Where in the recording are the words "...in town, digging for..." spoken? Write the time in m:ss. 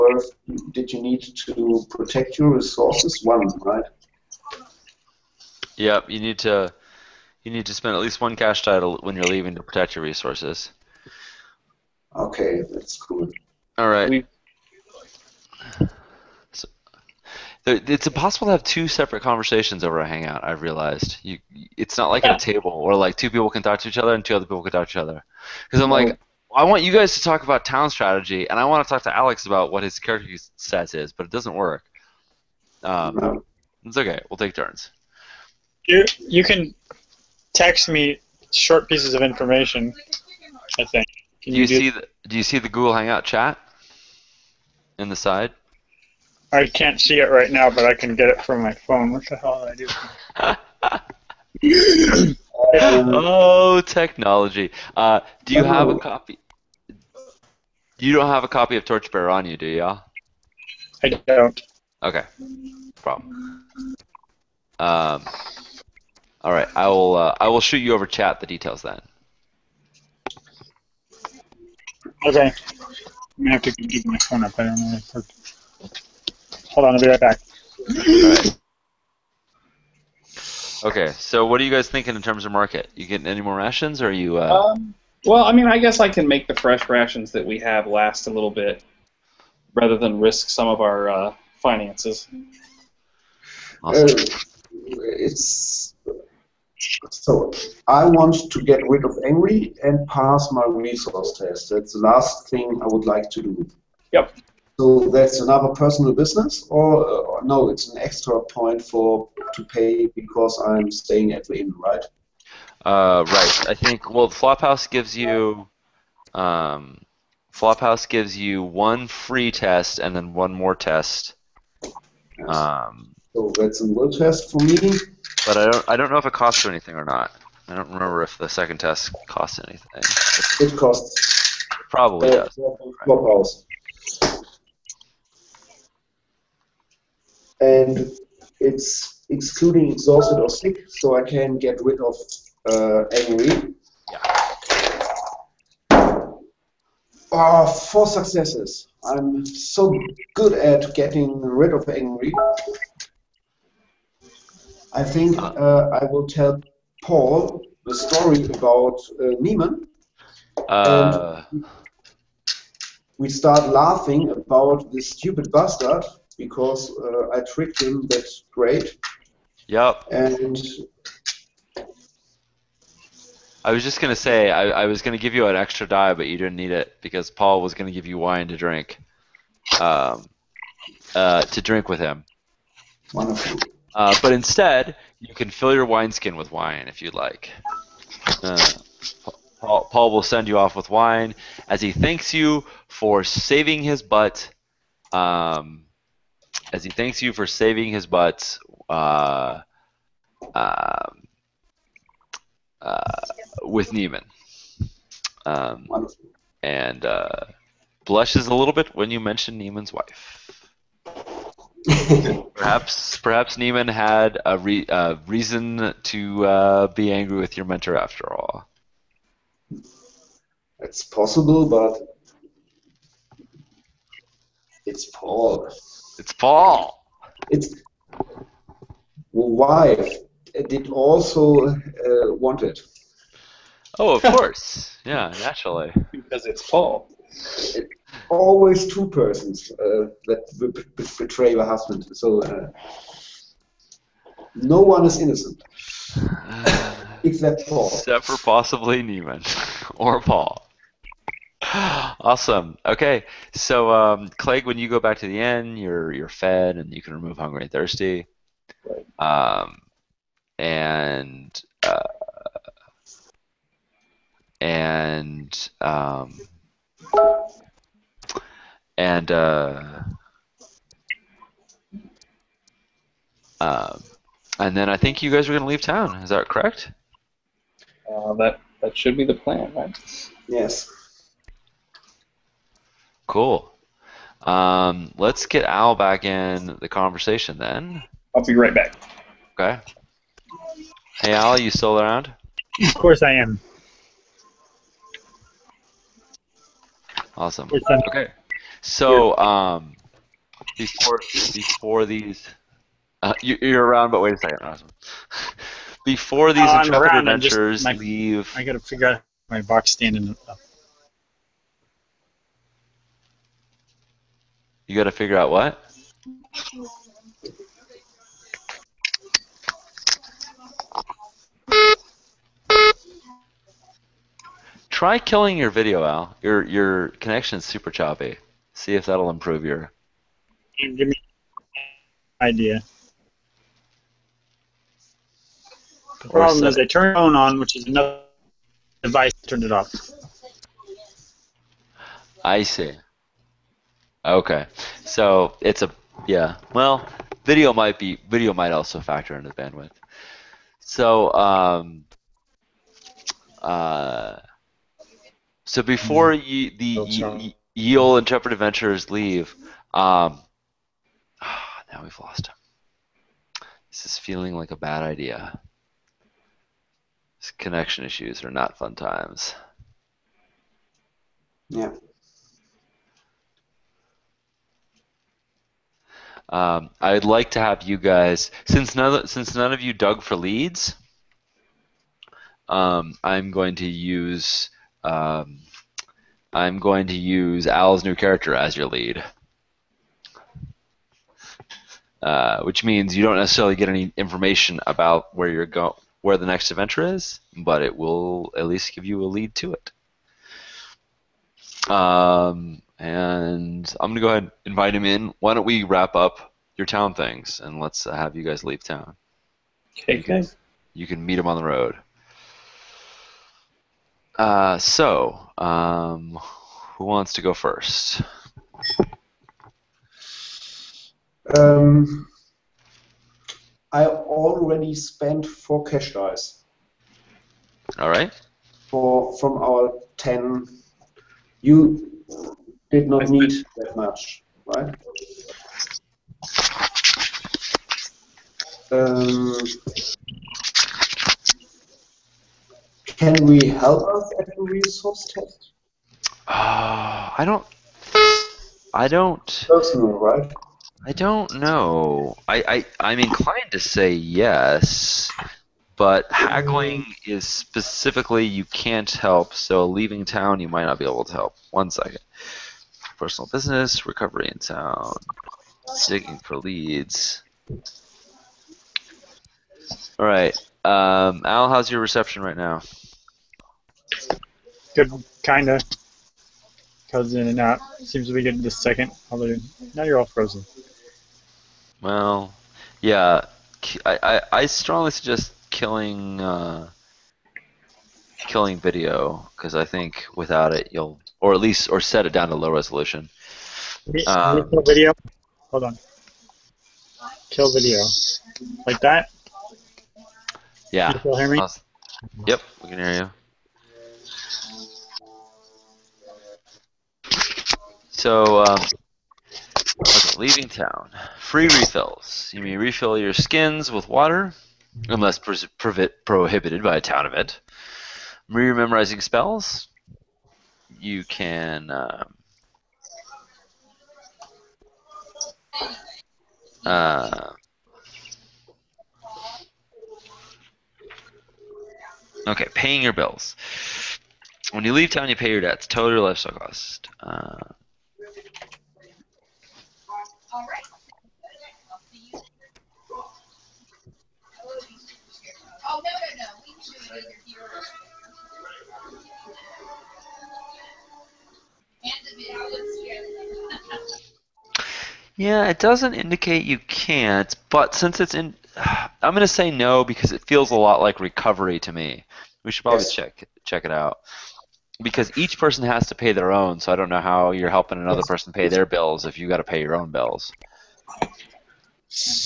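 7:44.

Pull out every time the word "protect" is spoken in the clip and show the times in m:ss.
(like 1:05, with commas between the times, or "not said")
0:01, 0:09.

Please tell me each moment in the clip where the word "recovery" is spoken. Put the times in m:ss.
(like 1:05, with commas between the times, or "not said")
7:44, 9:21.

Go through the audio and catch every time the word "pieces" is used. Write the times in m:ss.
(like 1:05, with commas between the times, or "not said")
0:38.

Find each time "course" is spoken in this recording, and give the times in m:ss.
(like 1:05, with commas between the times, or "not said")
3:54, 4:52.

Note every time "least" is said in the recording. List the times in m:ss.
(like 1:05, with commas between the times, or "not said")
0:08, 6:38, 8:11.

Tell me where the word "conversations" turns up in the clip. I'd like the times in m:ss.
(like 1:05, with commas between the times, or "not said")
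0:19, 4:46.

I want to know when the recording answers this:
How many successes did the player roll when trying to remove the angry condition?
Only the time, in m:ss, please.
2:27.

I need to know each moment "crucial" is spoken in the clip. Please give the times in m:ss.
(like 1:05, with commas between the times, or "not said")
not said.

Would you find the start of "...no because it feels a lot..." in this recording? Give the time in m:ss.
9:19.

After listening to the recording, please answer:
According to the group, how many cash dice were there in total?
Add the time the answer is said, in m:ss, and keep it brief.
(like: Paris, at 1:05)
10, at 7:10.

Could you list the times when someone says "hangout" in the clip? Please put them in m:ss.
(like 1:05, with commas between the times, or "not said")
0:20, 0:42.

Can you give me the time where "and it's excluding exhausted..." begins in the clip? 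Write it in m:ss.
2:17.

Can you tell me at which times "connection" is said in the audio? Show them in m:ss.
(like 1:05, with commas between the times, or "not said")
5:27, 6:07.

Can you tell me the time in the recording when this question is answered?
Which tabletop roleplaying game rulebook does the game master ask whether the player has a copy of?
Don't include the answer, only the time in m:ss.
0:58.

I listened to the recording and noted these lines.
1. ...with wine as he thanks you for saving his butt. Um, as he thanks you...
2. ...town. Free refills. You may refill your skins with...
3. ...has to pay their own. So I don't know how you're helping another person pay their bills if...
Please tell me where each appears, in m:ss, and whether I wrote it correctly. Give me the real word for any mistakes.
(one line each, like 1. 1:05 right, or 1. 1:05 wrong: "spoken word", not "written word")
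1. 3:10 right
2. 8:30 right
3. 9:25 right.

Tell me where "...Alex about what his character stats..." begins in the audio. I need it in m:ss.
0:29.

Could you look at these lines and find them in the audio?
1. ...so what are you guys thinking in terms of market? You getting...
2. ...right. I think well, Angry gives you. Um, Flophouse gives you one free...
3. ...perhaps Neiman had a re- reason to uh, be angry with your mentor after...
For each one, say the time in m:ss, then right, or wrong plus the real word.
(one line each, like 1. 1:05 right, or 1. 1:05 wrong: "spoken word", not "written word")
1. 1:21 right
2. 1:53 wrong: "Flophouse", not "Angry"
3. 3:33 right.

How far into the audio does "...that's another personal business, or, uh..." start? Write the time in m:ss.
1:45.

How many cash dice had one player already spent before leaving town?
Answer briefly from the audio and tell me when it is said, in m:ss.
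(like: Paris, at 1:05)
4, at 7:05.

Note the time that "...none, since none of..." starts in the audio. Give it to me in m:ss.
6:18.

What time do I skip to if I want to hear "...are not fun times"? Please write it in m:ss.
6:08.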